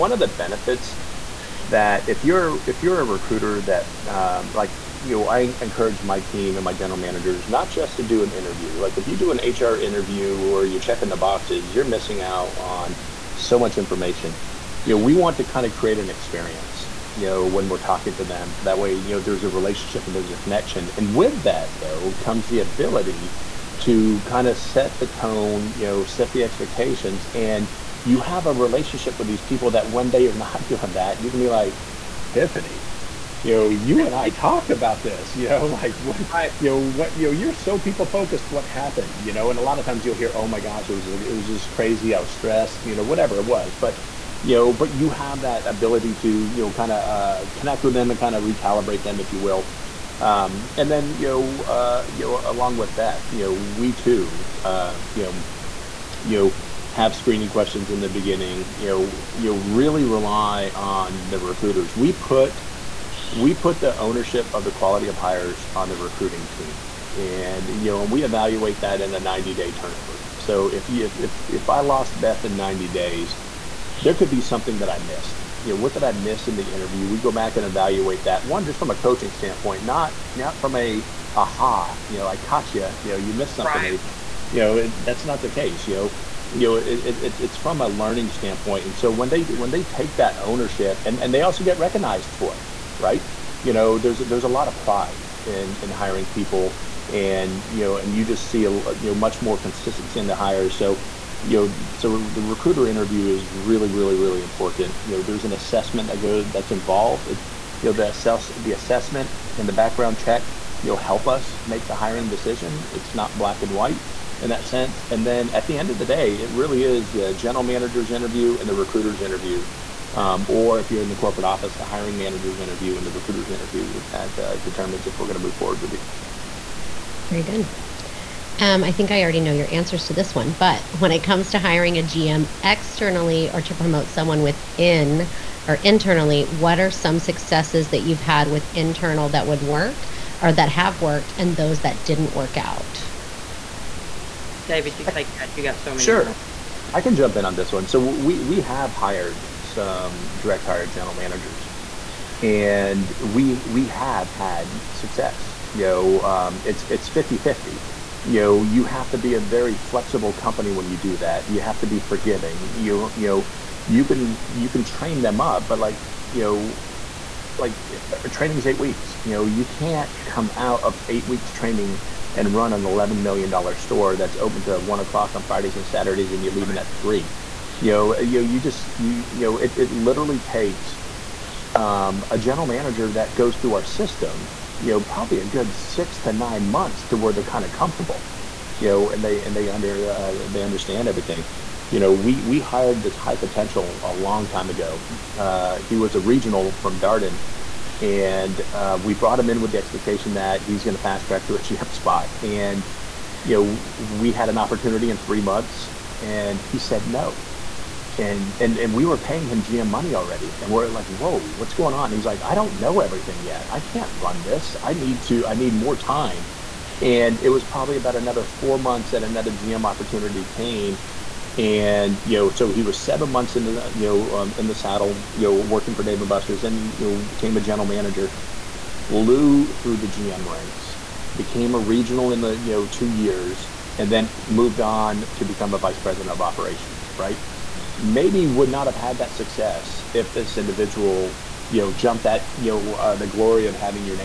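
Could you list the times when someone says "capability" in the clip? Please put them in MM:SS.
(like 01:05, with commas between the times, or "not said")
not said.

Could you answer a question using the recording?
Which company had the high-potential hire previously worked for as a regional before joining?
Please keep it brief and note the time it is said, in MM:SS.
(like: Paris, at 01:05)
Darden, at 03:16.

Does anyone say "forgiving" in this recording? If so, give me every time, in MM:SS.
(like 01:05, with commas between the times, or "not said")
02:41.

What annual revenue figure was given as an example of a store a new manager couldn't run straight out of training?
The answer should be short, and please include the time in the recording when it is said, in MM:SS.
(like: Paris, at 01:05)
$11 million, at 02:52.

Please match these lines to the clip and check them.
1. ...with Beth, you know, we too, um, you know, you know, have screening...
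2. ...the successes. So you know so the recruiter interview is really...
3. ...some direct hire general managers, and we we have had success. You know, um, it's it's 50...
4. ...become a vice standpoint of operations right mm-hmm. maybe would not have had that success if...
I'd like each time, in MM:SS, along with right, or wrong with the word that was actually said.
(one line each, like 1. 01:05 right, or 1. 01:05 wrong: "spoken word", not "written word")
1. 00:52 right
2. 01:40 wrong: "hires", not "successes"
3. 02:29 right
4. 03:55 wrong: "president", not "standpoint".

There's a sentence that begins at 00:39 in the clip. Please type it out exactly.
And a lot of times you'll hear, oh my gosh, it was, it was just crazy.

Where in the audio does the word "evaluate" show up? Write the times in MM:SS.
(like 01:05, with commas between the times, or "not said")
01:08, 01:17.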